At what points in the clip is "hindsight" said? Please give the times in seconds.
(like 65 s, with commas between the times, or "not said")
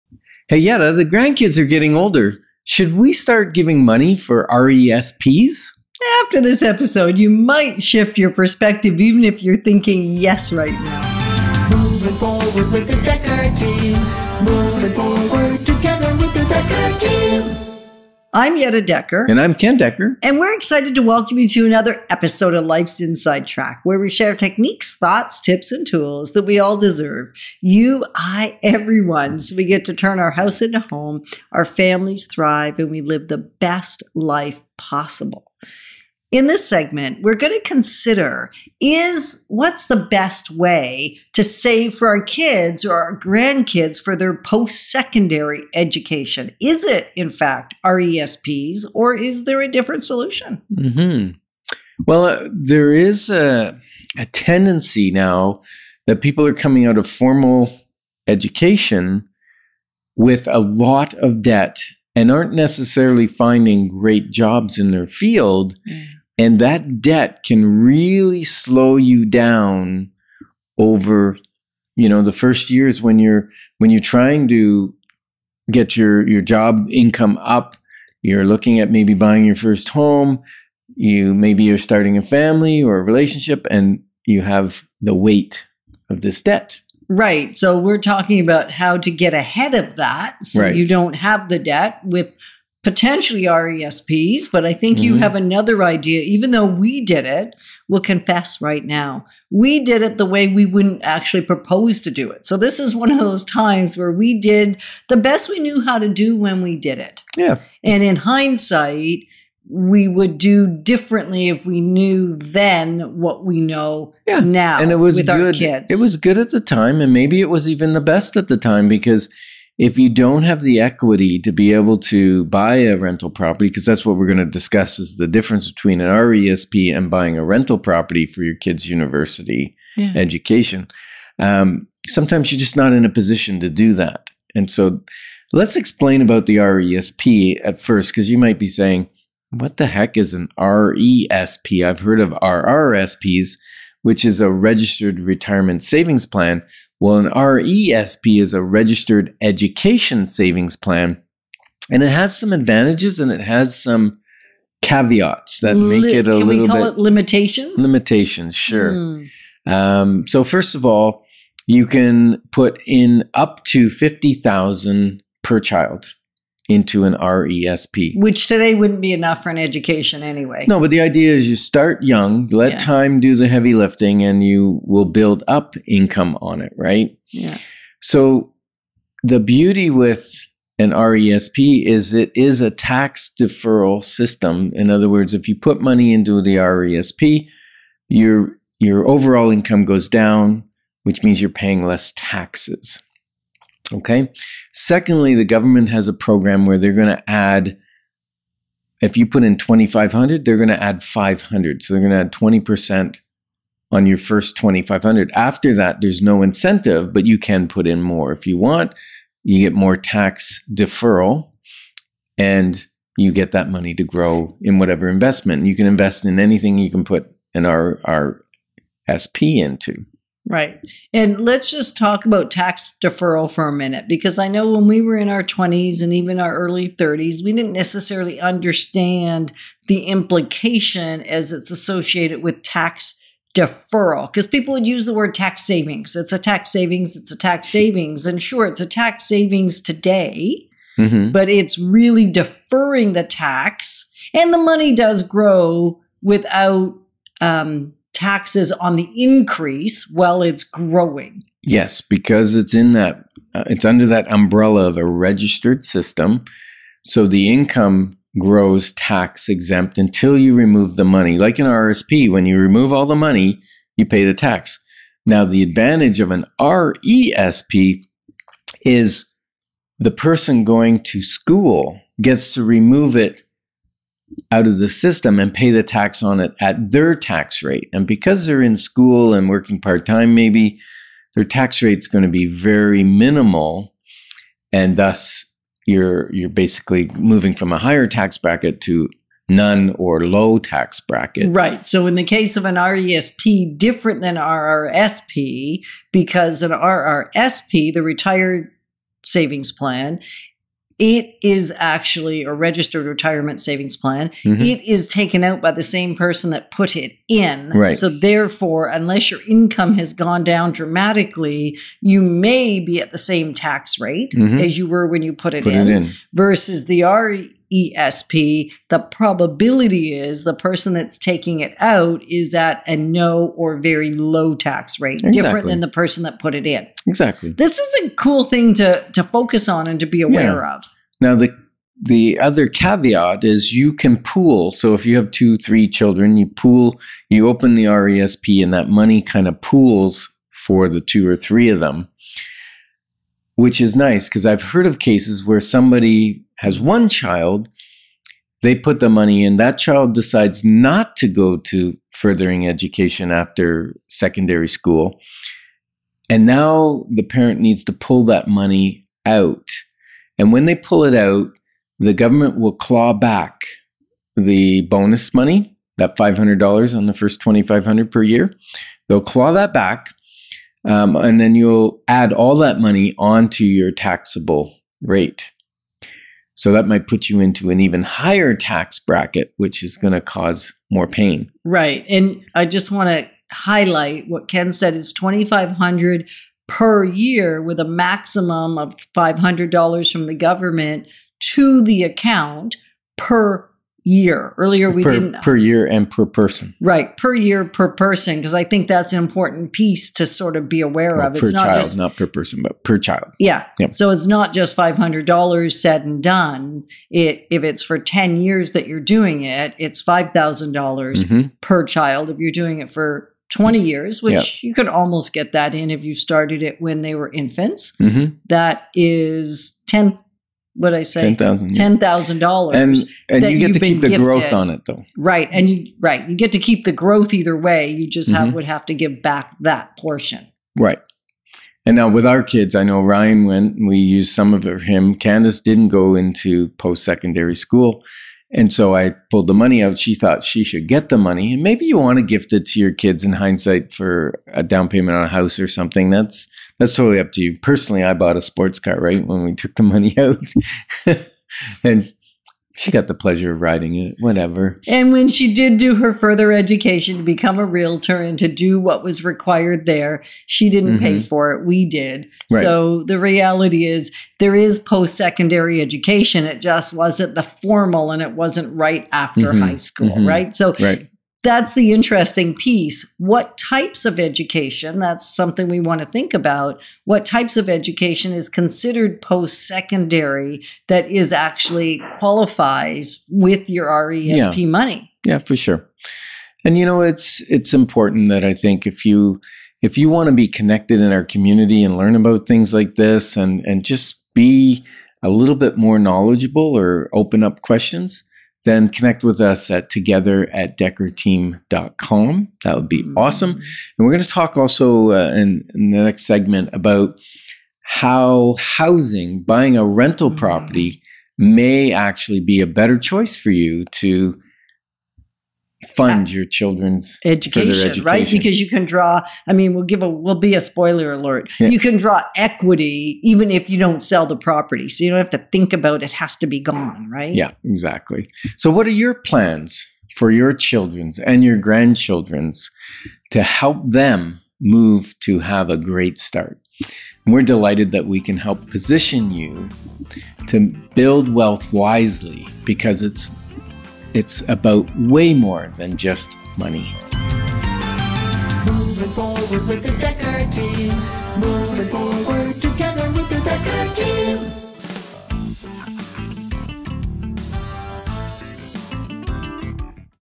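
108 s, 443 s.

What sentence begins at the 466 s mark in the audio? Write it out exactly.
It just wasn't the formal and it wasn't right after mm-hmm.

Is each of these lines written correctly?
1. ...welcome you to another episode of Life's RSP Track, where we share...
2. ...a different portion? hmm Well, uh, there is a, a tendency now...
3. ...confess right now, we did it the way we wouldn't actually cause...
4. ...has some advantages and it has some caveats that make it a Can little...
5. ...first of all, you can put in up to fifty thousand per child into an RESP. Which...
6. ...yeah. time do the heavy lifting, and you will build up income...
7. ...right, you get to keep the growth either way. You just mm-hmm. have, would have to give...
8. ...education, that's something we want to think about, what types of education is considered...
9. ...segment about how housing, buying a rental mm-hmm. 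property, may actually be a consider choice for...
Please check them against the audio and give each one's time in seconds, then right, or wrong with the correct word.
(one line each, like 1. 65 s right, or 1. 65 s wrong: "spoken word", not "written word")
1. 21 s wrong: "Inside", not "RSP"
2. 49 s wrong: "solution", not "portion"
3. 98 s wrong: "propose", not "cause"
4. 152 s right
5. 160 s right
6. 172 s right
7. 425 s right
8. 474 s right
9. 506 s wrong: "better", not "consider".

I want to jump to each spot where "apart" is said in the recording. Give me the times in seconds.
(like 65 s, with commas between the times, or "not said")
not said.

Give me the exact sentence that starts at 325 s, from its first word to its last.
different than the person that put it in.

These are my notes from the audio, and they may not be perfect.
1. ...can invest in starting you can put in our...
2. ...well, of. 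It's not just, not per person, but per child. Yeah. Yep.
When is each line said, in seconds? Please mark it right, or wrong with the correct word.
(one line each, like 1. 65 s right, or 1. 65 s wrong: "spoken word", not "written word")
1. 215 s wrong: "anything", not "starting"
2. 401 s right.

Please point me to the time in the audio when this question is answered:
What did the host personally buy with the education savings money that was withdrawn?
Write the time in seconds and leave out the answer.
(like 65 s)
448 s.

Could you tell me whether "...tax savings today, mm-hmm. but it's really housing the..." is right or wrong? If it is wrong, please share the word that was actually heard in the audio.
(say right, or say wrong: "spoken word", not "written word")
wrong: "deferring", not "housing".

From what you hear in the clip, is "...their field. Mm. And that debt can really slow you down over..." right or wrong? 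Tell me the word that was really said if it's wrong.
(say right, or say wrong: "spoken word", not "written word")
right.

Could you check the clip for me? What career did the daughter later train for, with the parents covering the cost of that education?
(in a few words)
Realtor.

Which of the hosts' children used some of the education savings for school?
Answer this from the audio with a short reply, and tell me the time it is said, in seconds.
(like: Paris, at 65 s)
Ryan, at 433 s.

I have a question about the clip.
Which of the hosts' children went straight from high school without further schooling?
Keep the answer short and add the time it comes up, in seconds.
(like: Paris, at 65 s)
Candace, at 435 s.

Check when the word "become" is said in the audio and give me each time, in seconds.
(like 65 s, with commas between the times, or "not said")
457 s.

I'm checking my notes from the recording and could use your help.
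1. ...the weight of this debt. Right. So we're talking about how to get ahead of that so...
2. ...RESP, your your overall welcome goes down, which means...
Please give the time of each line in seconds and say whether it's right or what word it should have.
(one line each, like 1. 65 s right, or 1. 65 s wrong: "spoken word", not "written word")
1. 84 s right
2. 186 s wrong: "income", not "welcome".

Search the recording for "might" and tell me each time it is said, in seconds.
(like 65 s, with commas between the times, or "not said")
7 s, 138 s, 376 s.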